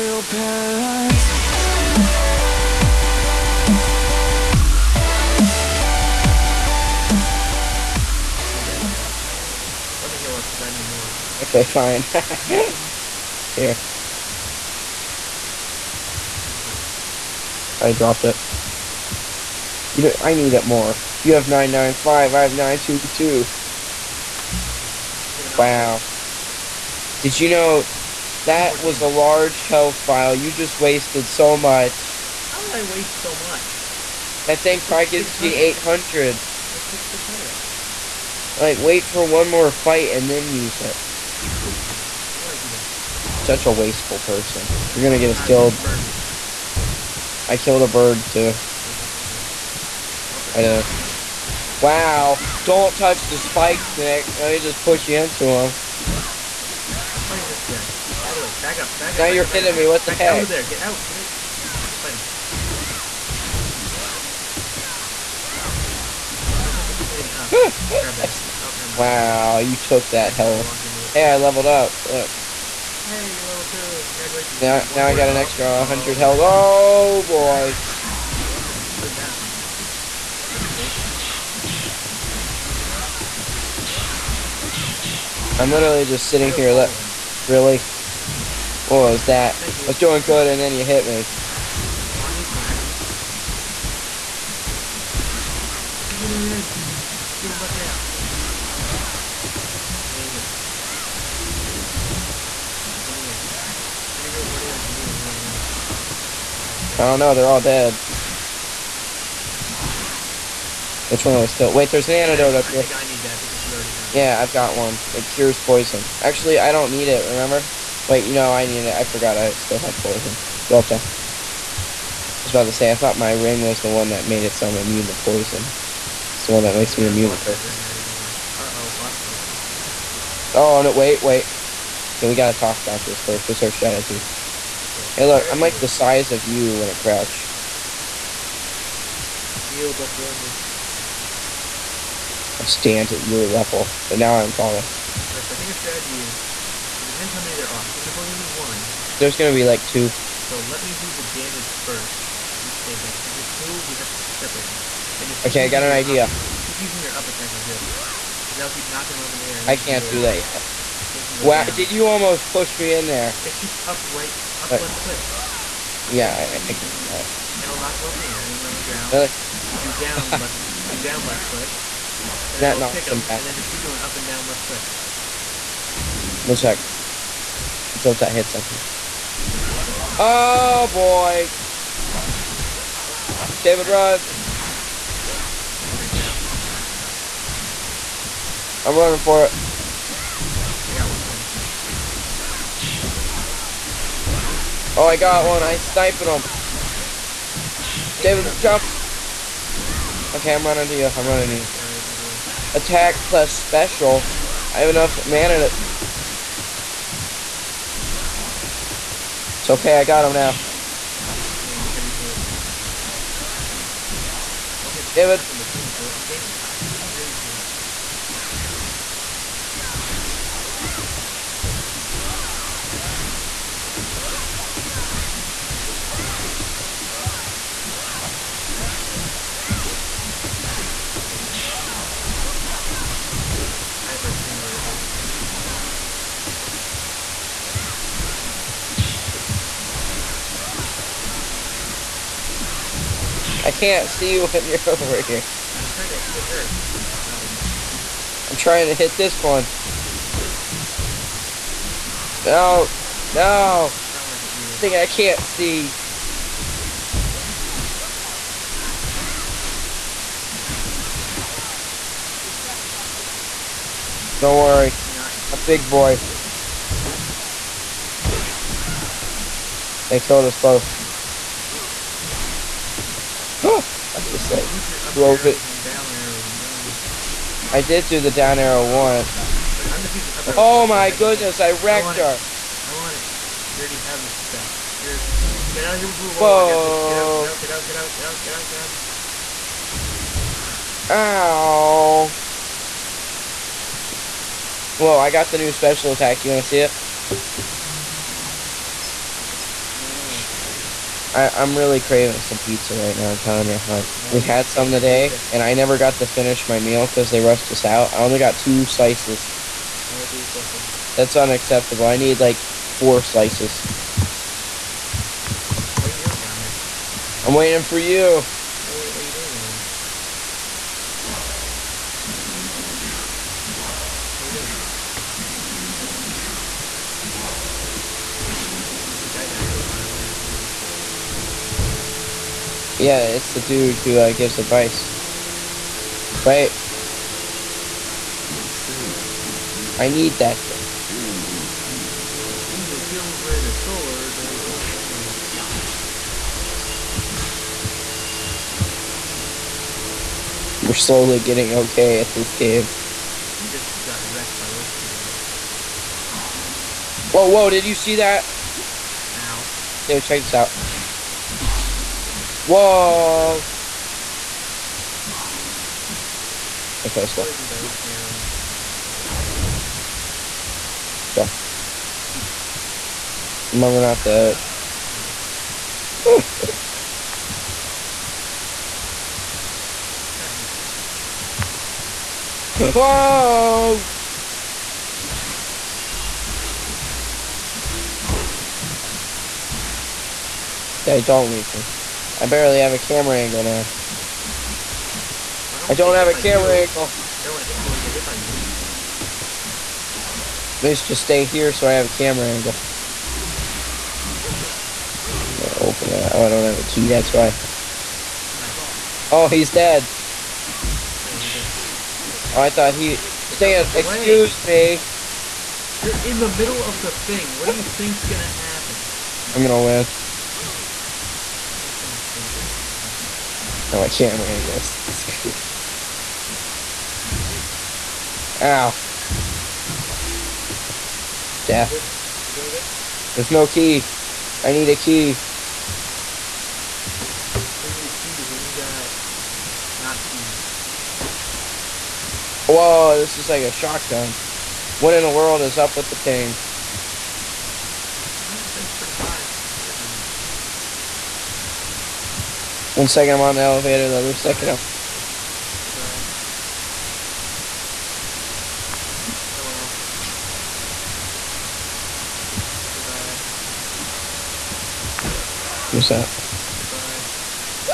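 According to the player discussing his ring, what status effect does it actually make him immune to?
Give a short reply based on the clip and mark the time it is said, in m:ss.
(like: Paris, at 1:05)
curse, at 2:07.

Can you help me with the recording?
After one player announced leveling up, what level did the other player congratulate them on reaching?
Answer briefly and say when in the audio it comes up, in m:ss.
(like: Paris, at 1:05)
2, at 1:13.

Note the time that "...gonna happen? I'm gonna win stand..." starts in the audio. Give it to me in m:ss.
6:58.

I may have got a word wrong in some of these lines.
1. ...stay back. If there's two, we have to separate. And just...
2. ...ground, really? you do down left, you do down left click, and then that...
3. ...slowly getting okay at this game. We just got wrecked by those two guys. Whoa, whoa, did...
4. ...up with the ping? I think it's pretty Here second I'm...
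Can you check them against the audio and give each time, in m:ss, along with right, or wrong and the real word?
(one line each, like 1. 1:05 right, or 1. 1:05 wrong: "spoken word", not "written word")
1. 2:32 right
2. 2:48 right
3. 5:50 right
4. 7:25 wrong: "One", not "Here".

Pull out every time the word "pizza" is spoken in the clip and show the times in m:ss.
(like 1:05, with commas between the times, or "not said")
5:02, 5:10.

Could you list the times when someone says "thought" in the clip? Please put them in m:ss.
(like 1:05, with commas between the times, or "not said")
2:02, 6:52.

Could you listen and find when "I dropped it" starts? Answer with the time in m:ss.
0:17.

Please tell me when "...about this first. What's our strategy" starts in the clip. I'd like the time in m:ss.
2:12.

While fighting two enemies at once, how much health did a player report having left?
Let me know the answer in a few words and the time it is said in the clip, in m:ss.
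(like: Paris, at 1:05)
282, at 3:36.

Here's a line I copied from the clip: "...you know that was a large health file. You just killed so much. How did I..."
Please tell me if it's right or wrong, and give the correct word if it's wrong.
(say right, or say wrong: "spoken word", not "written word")
wrong: "wasted", not "killed".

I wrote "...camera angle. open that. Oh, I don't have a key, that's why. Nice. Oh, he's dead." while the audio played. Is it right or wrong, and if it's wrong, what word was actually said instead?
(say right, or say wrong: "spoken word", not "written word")
right.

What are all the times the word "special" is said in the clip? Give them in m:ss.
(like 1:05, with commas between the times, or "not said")
3:23, 4:55.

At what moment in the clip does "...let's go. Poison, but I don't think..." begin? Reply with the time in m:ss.
6:07.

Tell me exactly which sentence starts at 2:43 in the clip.
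It's just up right, up left click.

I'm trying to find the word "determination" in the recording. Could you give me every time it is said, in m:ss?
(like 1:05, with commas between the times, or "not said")
not said.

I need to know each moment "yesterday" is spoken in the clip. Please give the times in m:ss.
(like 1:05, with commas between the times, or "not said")
not said.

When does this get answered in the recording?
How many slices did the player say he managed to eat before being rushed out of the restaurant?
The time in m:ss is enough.
5:08.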